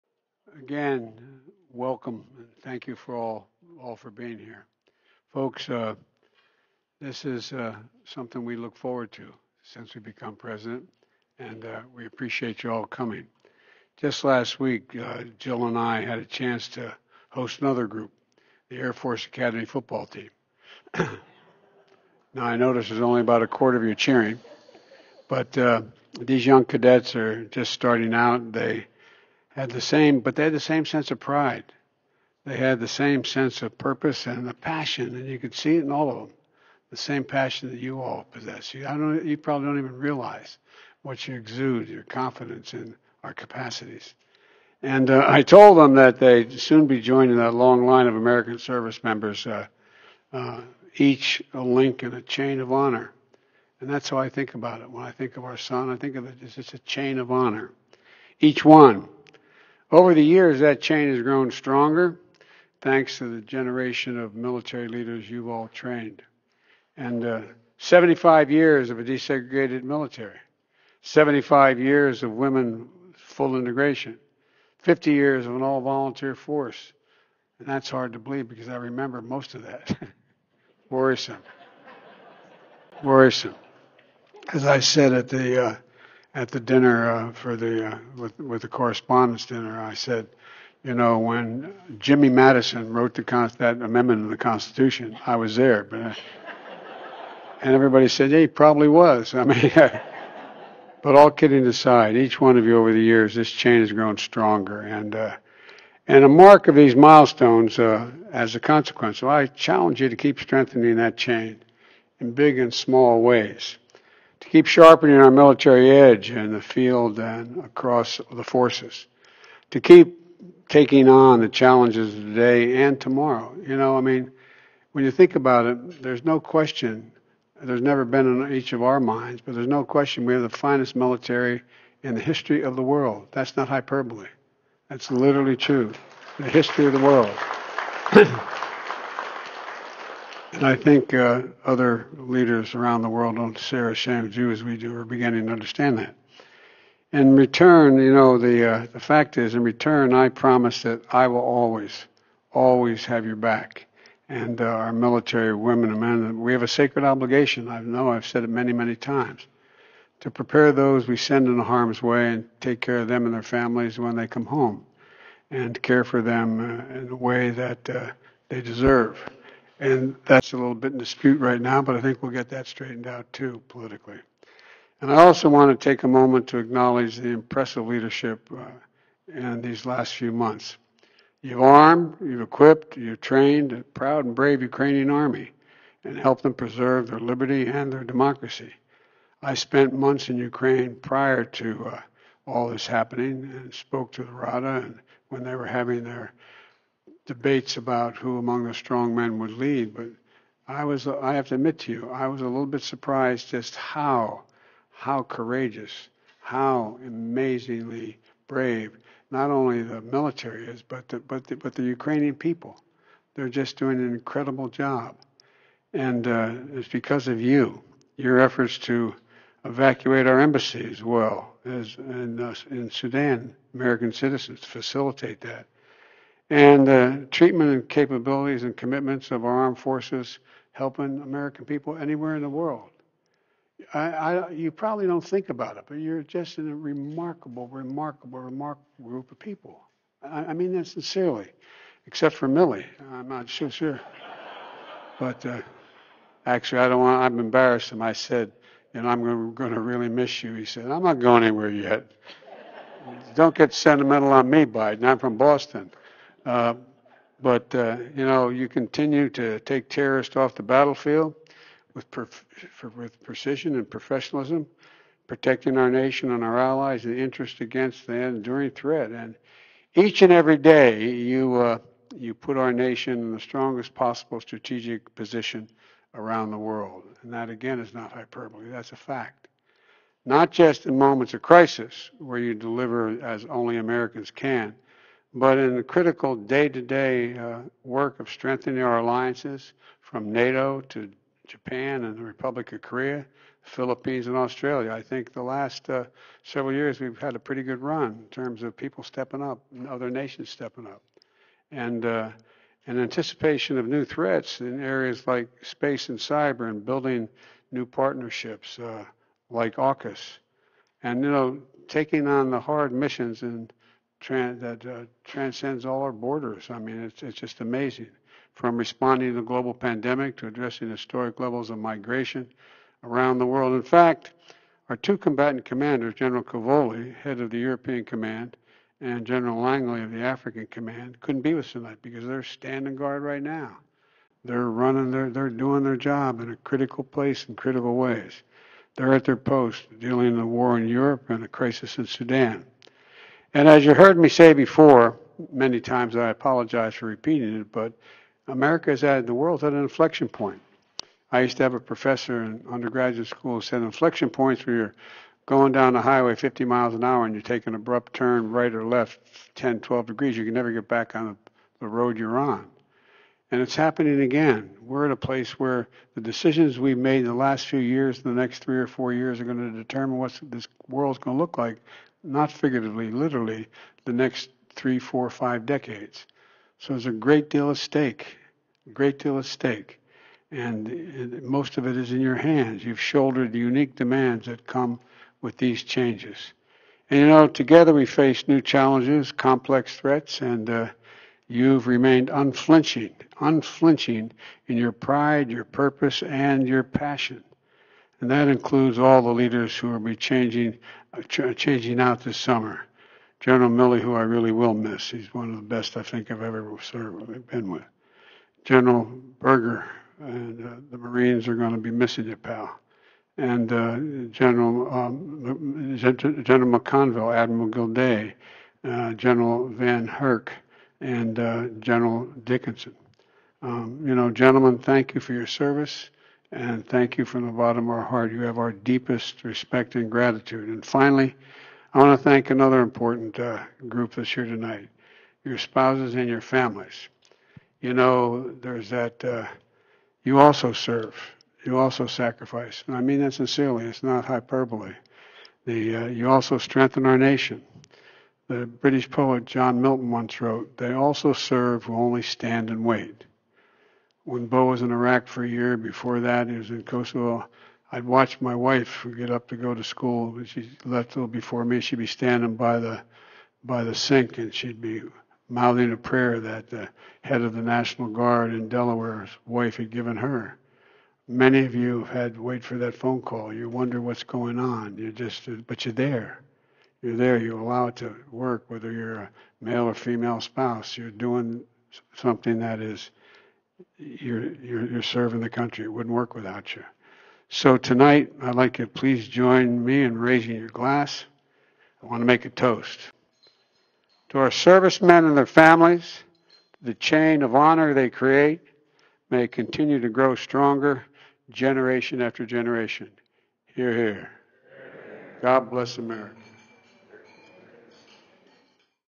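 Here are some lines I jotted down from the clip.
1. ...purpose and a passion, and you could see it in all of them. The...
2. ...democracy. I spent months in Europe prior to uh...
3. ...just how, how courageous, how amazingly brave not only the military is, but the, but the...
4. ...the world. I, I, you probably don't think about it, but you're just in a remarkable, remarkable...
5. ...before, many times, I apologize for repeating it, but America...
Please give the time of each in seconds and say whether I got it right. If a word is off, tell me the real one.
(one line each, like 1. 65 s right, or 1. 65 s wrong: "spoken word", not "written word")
1. 33 s right
2. 188 s wrong: "Ukraine", not "Europe"
3. 203 s right
4. 232 s right
5. 344 s right.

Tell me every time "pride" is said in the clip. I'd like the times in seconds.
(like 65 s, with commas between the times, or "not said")
31 s, 394 s.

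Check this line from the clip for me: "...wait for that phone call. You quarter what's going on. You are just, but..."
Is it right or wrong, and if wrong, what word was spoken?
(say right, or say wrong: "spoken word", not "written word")
wrong: "wonder", not "quarter".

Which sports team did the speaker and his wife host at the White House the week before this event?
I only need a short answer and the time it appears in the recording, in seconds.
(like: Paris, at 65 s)
Air Force Academy football team, at 18 s.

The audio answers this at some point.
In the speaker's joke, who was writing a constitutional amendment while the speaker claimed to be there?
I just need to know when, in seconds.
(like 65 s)
91 s.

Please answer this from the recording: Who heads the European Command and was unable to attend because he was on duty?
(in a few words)
General Cavoli.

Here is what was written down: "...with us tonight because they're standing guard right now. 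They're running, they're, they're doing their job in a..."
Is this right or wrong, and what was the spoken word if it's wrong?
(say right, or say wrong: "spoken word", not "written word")
right.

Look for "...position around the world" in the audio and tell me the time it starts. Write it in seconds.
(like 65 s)
275 s.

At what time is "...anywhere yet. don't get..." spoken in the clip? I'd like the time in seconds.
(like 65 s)
251 s.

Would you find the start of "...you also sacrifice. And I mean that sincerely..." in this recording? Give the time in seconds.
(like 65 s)
441 s.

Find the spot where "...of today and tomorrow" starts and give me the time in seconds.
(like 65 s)
122 s.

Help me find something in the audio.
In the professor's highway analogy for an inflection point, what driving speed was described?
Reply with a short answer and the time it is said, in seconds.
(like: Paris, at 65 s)
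50 miles an hour, at 356 s.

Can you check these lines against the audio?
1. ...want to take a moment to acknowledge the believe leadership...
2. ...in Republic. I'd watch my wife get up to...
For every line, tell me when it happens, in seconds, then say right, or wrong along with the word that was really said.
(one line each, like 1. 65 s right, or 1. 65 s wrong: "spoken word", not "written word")
1. 175 s wrong: "impressive", not "believe"
2. 456 s wrong: "Kosovo", not "Republic".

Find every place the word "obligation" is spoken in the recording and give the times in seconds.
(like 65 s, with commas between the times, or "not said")
157 s.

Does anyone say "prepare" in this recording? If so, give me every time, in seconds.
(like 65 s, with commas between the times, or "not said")
160 s.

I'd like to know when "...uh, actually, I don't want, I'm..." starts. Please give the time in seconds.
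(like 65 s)
245 s.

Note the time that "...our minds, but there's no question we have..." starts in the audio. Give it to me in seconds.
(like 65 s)
128 s.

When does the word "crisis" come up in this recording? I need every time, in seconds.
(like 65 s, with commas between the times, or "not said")
281 s, 341 s.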